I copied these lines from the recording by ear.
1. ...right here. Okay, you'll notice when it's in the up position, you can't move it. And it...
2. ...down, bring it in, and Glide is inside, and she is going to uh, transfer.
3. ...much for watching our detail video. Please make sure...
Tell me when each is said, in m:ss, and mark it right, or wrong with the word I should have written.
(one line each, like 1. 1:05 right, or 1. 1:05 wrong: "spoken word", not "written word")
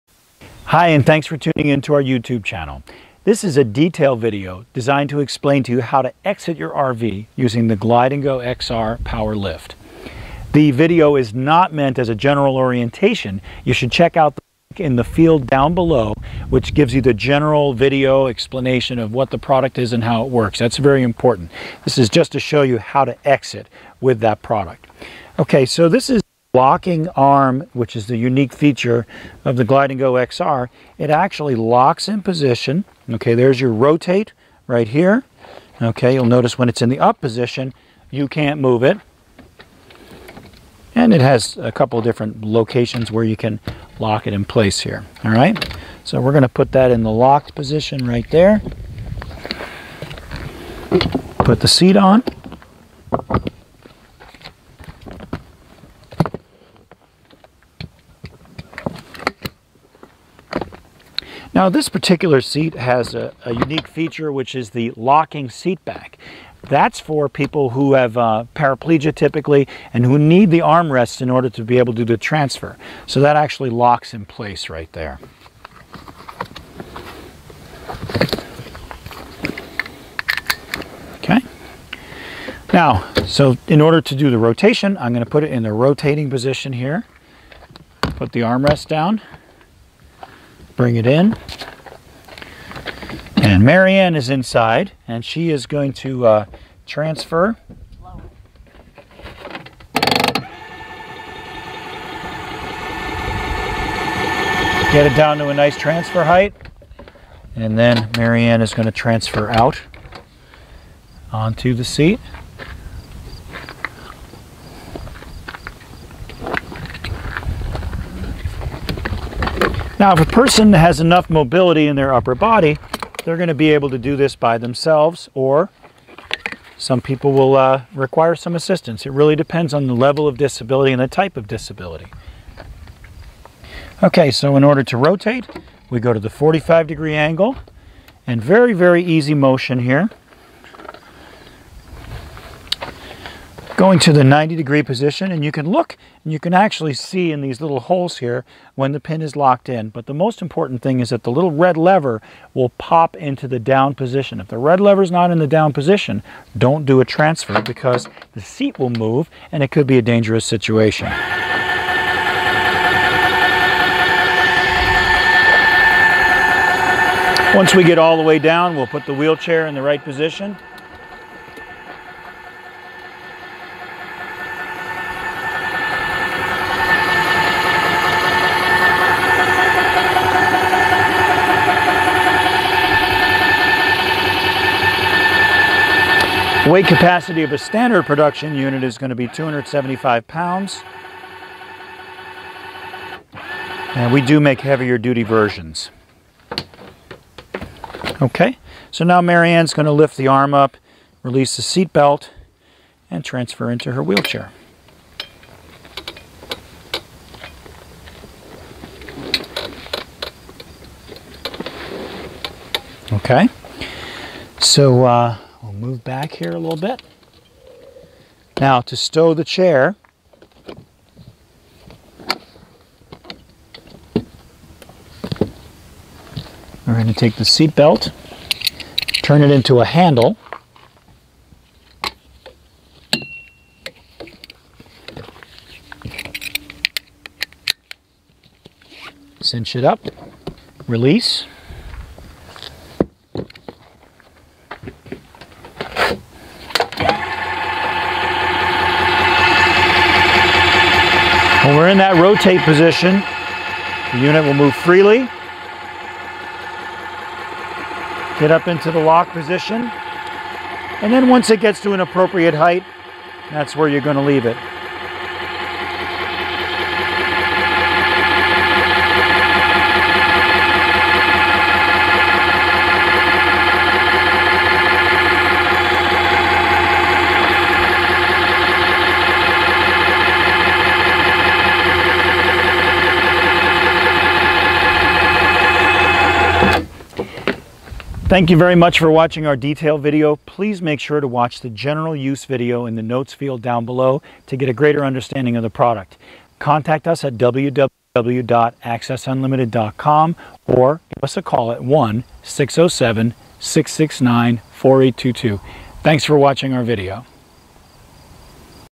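1. 0:34 right
2. 1:28 wrong: "Marianne", not "Glide"
3. 4:48 right.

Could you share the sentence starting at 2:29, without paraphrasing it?
But the most important thing is that the little red lever will pop into the down position.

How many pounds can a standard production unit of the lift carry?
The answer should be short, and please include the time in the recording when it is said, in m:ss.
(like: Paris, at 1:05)
275 pounds, at 3:09.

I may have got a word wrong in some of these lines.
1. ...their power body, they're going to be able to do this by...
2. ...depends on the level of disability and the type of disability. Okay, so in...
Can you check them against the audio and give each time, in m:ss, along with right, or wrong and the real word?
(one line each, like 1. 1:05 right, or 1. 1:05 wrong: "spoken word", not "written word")
1. 2:01 wrong: "upper", not "power"
2. 2:09 right.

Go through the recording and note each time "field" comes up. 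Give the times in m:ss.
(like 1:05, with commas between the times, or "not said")
0:15, 4:53.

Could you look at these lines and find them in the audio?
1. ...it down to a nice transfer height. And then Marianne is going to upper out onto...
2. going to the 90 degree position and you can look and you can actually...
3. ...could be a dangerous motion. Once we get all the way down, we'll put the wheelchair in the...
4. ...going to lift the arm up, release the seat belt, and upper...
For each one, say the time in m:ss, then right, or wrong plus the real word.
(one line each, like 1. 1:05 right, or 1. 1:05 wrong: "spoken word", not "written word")
1. 1:45 wrong: "transfer", not "upper"
2. 2:23 right
3. 2:39 wrong: "situation", not "motion"
4. 3:19 wrong: "transfer", not "upper".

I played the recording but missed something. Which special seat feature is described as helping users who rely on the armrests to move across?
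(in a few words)
locking seat back.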